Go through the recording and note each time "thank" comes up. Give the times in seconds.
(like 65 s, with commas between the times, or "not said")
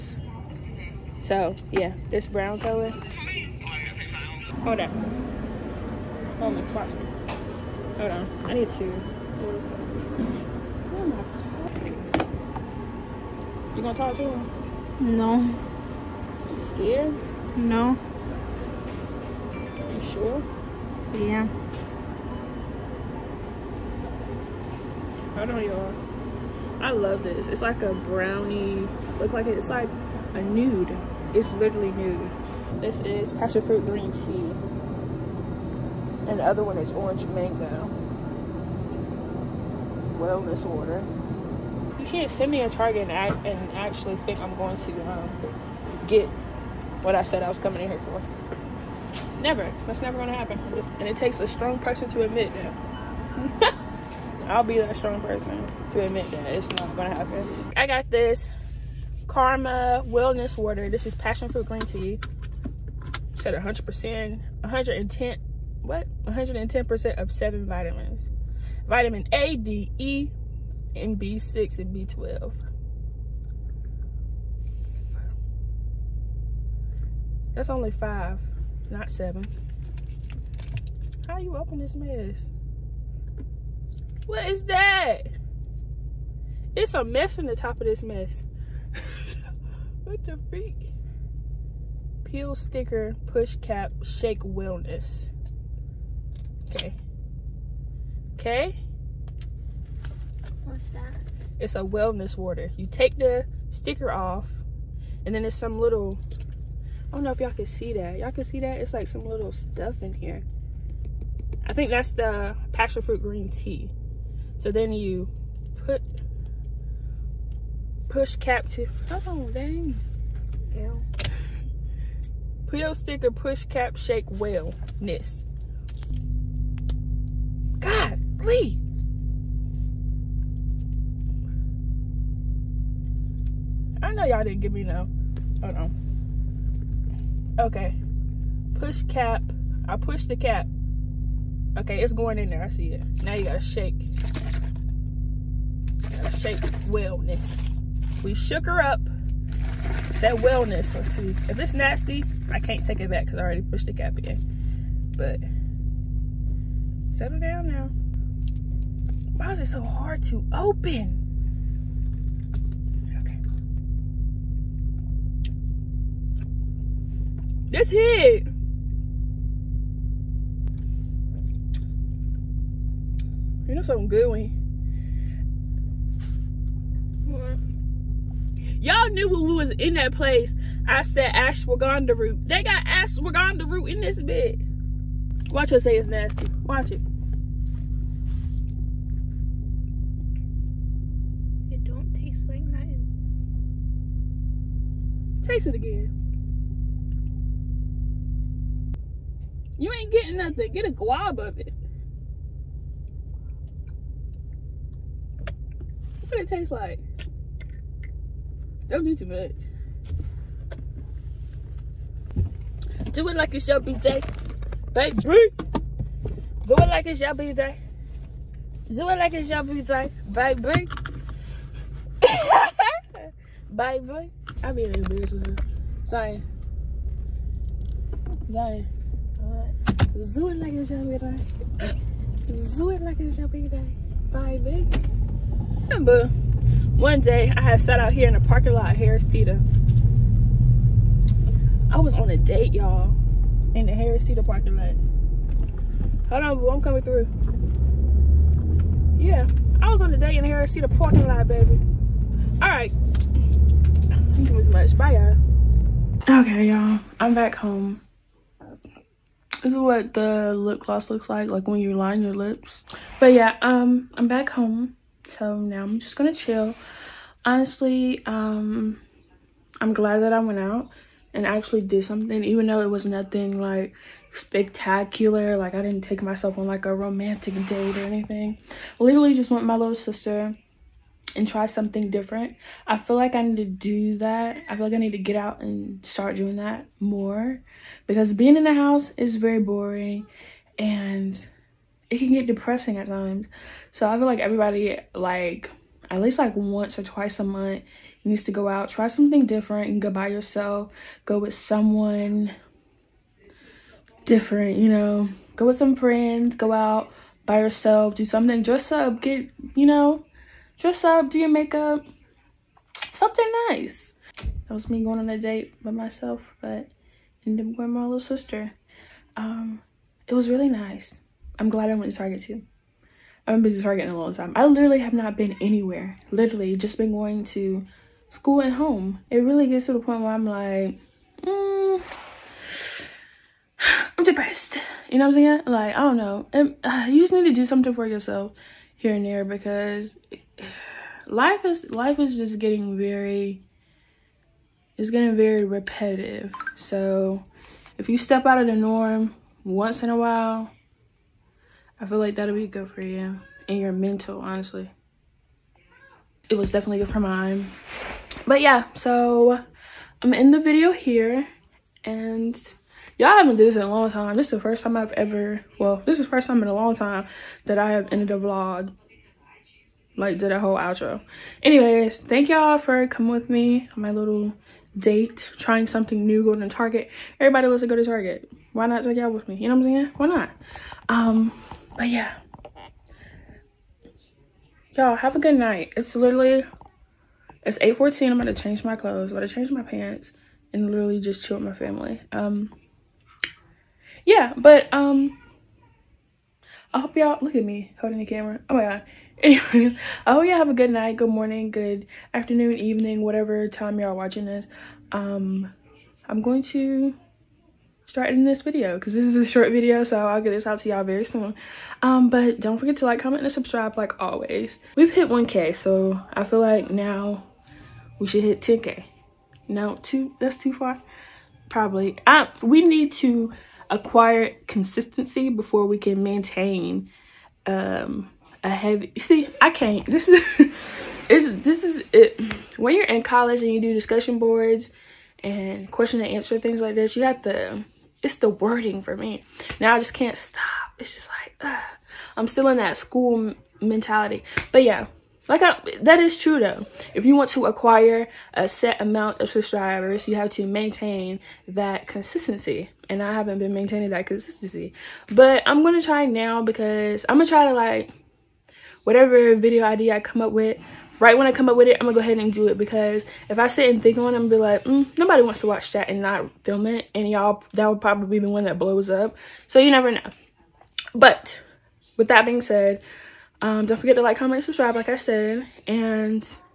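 254 s, 372 s.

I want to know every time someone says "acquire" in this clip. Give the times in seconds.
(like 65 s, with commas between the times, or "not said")
423 s, 447 s.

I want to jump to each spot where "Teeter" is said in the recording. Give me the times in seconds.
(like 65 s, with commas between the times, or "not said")
239 s, 244 s, 250 s.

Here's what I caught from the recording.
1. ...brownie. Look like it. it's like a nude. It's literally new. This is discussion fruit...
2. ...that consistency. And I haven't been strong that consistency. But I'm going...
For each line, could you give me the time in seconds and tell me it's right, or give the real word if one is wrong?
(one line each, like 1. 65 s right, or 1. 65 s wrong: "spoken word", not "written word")
1. 27 s wrong: "passion", not "discussion"
2. 451 s wrong: "maintaining", not "strong".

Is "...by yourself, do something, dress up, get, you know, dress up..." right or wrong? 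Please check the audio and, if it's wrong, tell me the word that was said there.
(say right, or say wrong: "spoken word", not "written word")
right.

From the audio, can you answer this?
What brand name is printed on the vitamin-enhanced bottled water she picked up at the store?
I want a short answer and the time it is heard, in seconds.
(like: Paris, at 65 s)
Karma, at 59 s.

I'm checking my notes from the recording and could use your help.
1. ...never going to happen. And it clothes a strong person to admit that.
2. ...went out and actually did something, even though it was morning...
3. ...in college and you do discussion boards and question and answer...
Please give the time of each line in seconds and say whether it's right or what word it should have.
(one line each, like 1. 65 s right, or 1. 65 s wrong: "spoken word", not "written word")
1. 50 s wrong: "takes", not "clothes"
2. 270 s wrong: "nothing", not "morning"
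3. 433 s right.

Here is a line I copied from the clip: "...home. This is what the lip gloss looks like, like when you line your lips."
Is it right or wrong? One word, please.
right.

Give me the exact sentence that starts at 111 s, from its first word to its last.
I think that's the passion fruit green tea.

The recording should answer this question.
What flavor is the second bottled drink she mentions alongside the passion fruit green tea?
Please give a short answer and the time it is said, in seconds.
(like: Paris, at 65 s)
Orange mango, at 36 s.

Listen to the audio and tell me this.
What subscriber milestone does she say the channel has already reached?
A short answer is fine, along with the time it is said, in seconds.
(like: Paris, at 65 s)
1k, at 415 s.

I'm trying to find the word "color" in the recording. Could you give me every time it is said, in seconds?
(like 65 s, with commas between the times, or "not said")
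2 s.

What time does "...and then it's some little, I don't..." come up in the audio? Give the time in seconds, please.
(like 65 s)
105 s.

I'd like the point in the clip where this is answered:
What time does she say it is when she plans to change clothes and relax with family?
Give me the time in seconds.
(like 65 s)
387 s.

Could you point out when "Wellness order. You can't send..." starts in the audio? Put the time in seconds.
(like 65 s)
40 s.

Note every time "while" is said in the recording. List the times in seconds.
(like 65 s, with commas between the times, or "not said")
350 s.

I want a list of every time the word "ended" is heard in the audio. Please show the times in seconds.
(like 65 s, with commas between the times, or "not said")
317 s, 368 s.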